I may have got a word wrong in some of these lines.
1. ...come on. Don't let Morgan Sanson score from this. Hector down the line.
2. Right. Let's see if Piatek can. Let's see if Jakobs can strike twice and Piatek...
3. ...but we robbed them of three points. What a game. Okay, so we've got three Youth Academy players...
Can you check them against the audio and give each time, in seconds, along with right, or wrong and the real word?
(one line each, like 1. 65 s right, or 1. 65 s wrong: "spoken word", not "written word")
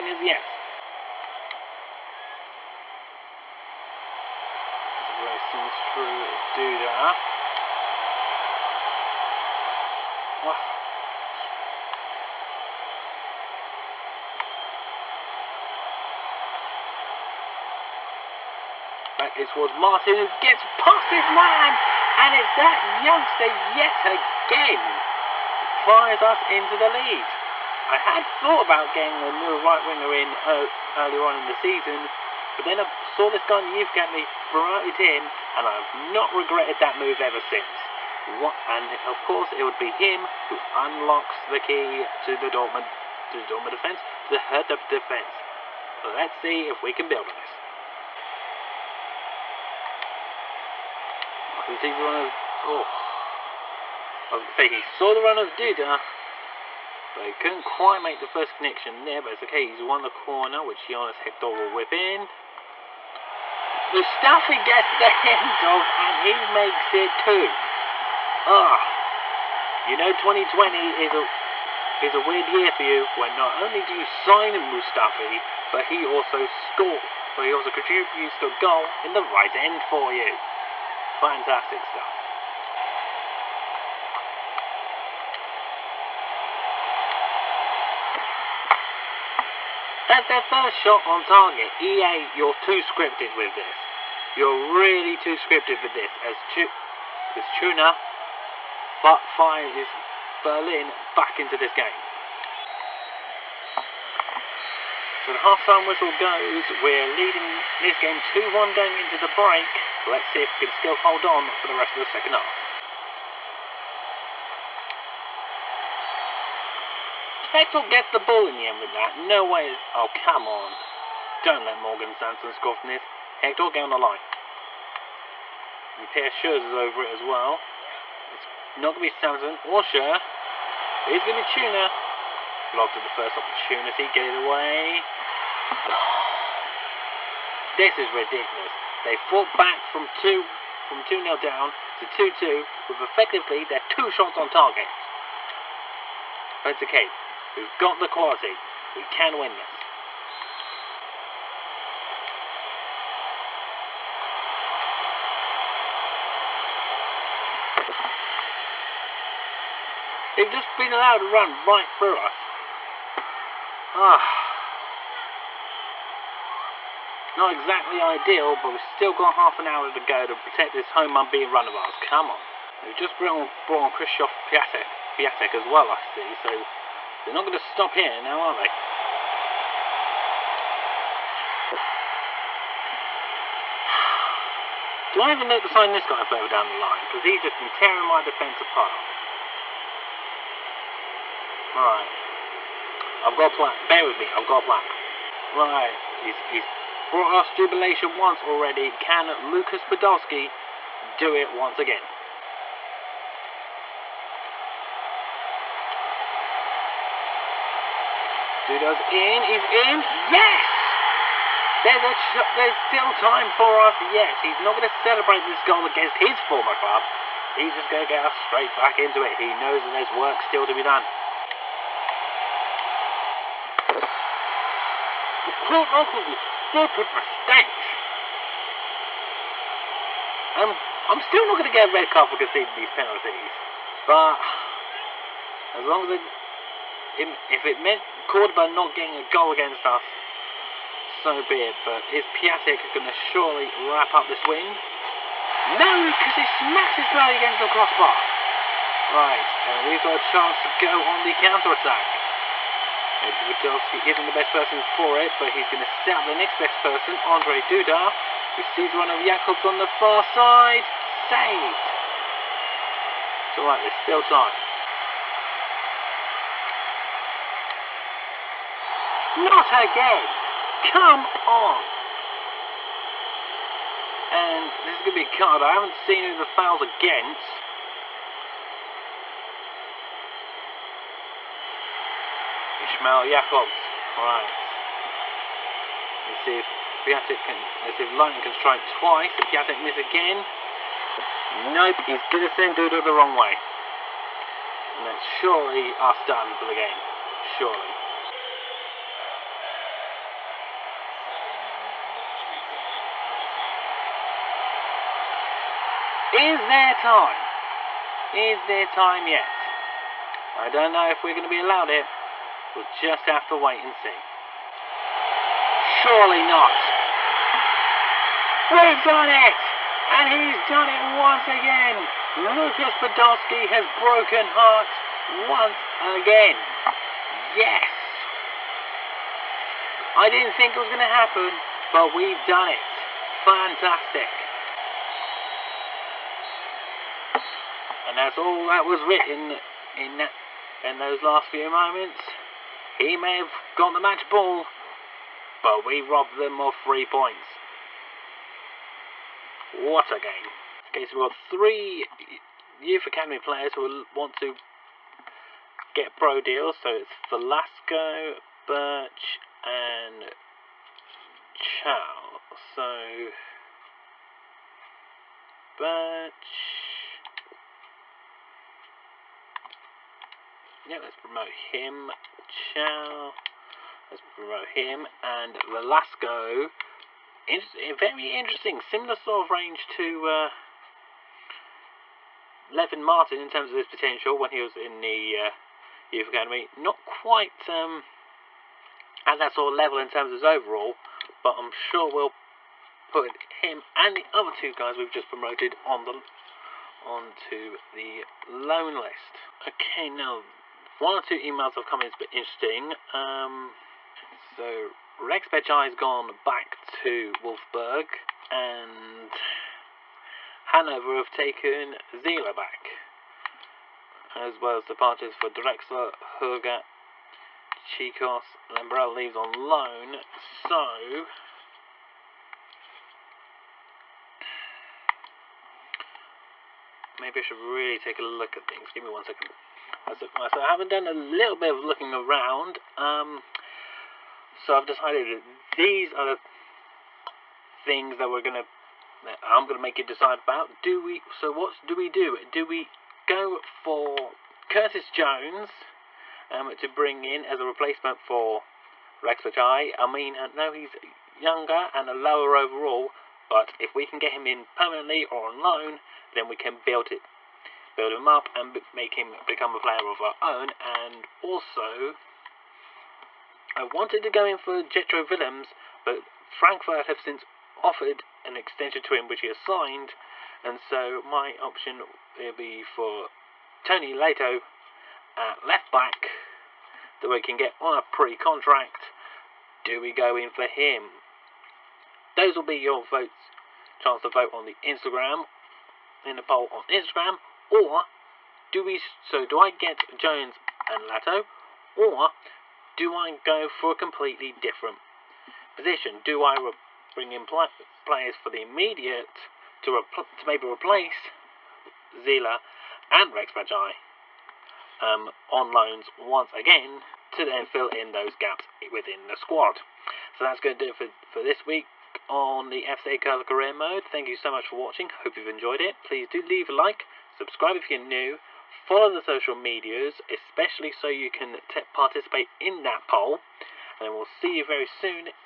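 1. 120 s right
2. 284 s wrong: "Lightning", not "Jakobs"
3. 345 s right.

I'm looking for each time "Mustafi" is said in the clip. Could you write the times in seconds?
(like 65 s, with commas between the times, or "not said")
63 s, 74 s.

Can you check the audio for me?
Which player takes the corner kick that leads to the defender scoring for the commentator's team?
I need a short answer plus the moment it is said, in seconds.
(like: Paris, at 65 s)
Jonas Hector, at 60 s.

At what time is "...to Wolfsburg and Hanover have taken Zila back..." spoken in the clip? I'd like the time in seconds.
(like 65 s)
406 s.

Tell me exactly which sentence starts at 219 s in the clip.
He knows that there's work still to be done.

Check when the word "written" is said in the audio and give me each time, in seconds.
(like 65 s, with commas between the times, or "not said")
339 s.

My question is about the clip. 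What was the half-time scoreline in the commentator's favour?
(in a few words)
2-1.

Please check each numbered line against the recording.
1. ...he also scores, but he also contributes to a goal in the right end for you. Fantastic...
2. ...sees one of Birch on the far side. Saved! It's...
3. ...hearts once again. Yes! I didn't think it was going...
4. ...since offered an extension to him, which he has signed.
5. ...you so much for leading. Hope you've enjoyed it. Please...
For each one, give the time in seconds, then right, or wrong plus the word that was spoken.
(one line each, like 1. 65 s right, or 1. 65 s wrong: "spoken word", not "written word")
1. 75 s right
2. 258 s wrong: "Jakobs", not "Birch"
3. 324 s right
4. 467 s right
5. 514 s wrong: "watching", not "leading".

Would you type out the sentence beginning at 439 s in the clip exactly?
That I'm gonna make you decide about.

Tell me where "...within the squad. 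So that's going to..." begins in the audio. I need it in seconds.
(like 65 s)
508 s.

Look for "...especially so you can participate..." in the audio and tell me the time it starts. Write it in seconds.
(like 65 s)
520 s.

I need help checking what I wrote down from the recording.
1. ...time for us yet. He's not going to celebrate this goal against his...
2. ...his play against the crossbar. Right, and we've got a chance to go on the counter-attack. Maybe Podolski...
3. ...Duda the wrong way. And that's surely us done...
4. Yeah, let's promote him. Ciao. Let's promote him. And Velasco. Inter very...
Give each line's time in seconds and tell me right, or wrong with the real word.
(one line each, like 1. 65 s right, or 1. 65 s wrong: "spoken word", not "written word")
1. 213 s right
2. 246 s right
3. 292 s right
4. 370 s right.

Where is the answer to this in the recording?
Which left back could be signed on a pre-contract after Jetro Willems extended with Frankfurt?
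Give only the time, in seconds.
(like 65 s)
473 s.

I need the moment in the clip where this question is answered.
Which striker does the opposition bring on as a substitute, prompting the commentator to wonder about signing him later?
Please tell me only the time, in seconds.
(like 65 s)
173 s.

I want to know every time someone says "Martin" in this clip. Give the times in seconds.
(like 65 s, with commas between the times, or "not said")
19 s, 383 s.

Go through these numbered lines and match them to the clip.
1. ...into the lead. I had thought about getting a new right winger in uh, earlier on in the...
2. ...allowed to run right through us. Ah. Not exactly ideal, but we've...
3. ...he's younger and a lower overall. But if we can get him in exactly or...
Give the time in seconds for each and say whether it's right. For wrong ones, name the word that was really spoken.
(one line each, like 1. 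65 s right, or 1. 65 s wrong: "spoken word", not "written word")
1. 26 s right
2. 160 s right
3. 450 s wrong: "permanently", not "exactly".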